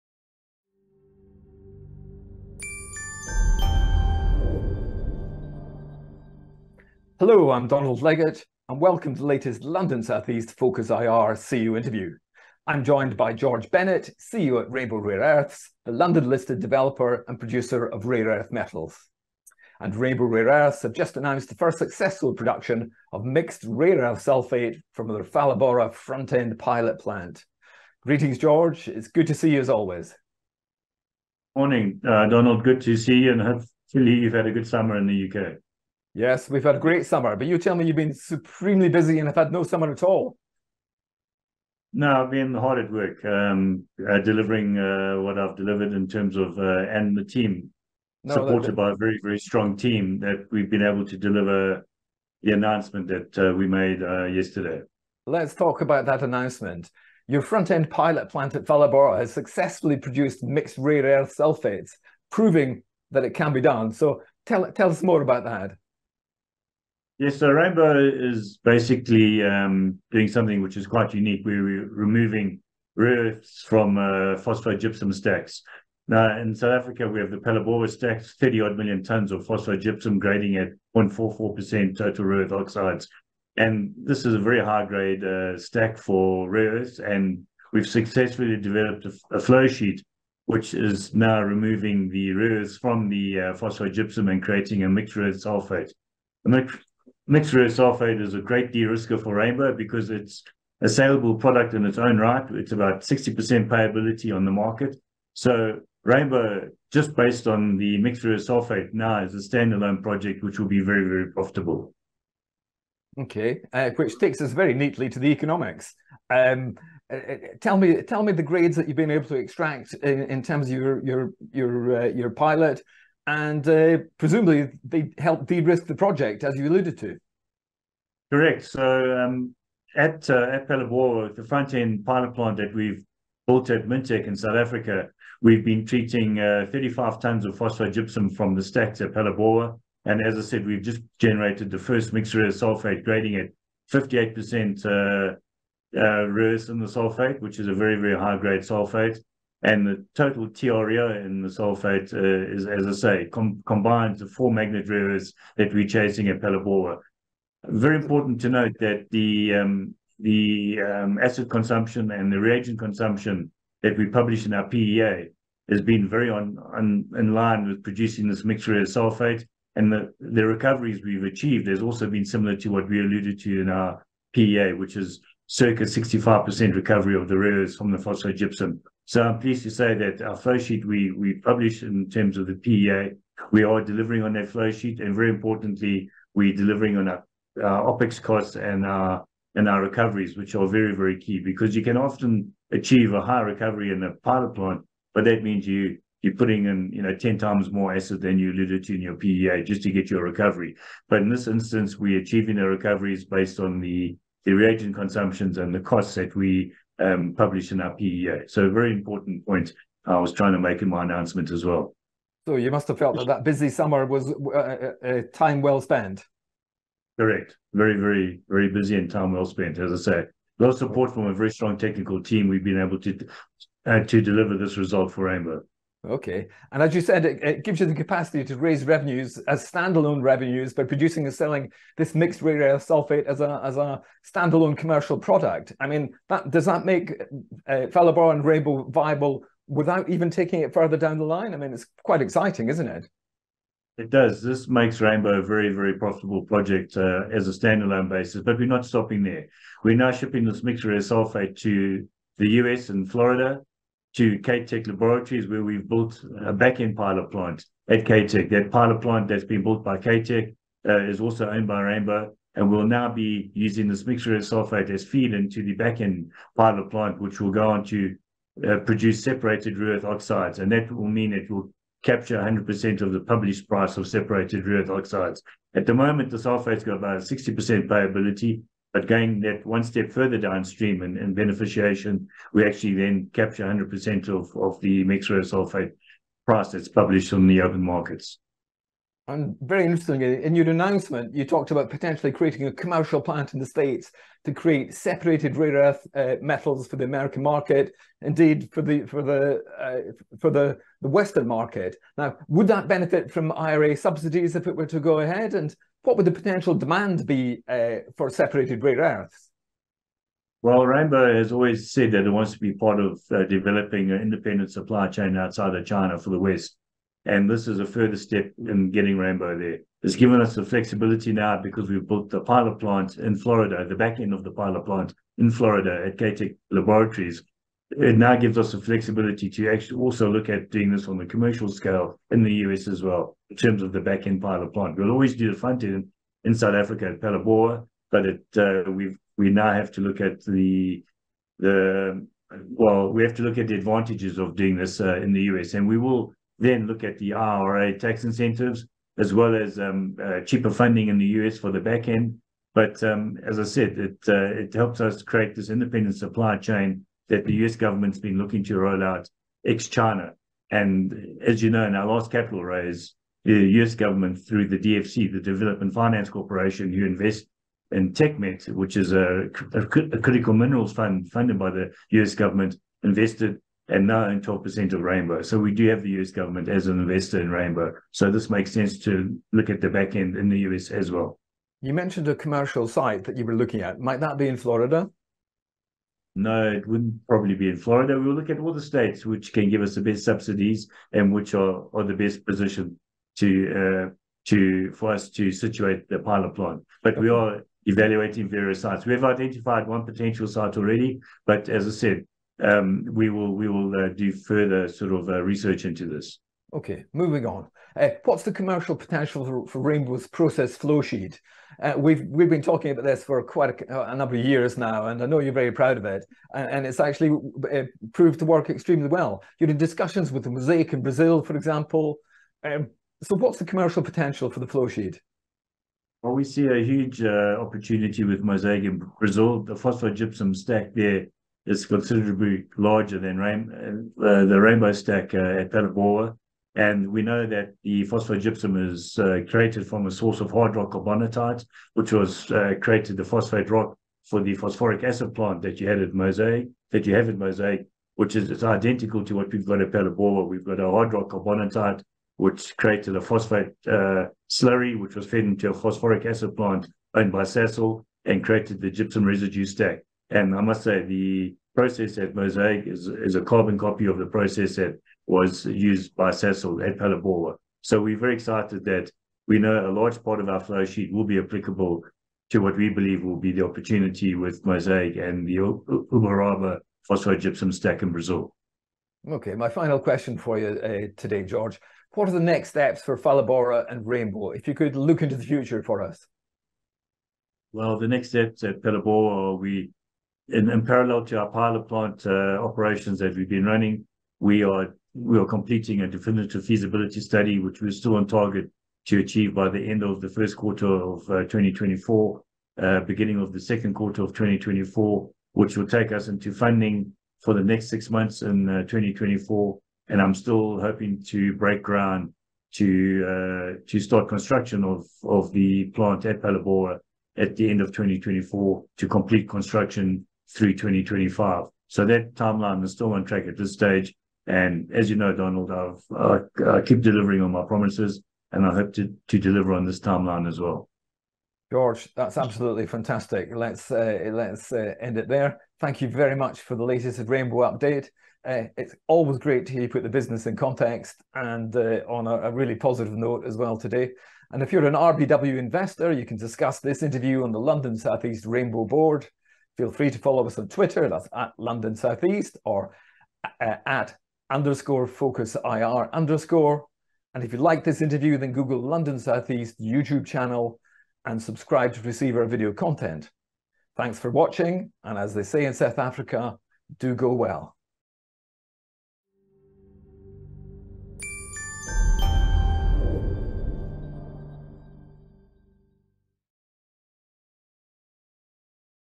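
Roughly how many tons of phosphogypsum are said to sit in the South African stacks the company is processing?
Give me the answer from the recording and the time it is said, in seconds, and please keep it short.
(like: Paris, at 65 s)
30 million, at 78 s.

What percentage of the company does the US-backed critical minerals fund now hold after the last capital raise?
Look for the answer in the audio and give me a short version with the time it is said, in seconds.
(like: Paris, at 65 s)
12%, at 374 s.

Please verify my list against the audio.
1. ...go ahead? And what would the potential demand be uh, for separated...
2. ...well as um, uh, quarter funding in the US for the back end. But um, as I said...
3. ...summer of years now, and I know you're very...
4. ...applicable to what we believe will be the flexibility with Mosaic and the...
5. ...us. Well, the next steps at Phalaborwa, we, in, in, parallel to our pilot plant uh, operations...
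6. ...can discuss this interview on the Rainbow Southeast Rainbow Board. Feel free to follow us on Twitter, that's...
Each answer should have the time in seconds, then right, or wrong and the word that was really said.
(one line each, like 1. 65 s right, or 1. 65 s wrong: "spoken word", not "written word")
1. 304 s right
2. 349 s wrong: "cheaper", not "quarter"
3. 414 s wrong: "number", not "summer"
4. 471 s wrong: "opportunity", not "flexibility"
5. 486 s right
6. 546 s wrong: "London", not "Rainbow".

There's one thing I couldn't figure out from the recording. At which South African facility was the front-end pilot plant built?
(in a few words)
Mintek.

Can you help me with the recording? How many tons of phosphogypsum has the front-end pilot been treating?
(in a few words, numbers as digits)
35 tons.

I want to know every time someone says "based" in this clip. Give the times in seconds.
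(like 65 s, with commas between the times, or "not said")
107 s, 203 s.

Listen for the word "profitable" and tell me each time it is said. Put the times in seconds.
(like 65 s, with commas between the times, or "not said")
111 s, 245 s.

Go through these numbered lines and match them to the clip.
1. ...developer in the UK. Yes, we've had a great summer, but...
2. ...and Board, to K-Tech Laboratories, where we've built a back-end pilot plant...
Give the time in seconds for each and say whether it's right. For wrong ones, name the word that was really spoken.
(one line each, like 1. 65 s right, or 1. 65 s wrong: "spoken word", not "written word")
1. 34 s wrong: "summer", not "developer"
2. 252 s wrong: "Florida", not "Board".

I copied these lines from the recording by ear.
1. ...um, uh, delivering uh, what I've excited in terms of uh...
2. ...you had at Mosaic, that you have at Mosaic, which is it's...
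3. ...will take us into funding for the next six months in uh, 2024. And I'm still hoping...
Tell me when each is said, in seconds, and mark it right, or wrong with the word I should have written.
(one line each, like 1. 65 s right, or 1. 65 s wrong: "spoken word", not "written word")
1. 43 s wrong: "delivered", not "excited"
2. 445 s right
3. 505 s right.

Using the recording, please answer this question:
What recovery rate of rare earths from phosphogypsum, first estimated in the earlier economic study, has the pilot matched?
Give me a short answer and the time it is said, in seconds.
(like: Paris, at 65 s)
65%, at 175 s.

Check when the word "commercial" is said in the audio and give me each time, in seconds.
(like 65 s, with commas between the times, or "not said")
234 s, 292 s, 331 s, 382 s, 408 s, 423 s.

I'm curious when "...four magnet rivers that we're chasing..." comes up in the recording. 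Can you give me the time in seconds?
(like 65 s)
154 s.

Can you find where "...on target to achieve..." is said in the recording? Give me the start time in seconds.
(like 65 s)
498 s.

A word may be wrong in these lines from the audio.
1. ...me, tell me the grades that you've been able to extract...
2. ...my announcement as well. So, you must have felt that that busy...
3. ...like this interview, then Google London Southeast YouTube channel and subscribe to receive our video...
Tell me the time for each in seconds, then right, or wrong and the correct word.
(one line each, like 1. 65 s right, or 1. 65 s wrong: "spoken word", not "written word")
1. 117 s right
2. 210 s right
3. 557 s right.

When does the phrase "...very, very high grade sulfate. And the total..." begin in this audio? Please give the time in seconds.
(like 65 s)
147 s.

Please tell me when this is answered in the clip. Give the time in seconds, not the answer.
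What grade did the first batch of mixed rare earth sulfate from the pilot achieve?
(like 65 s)
143 s.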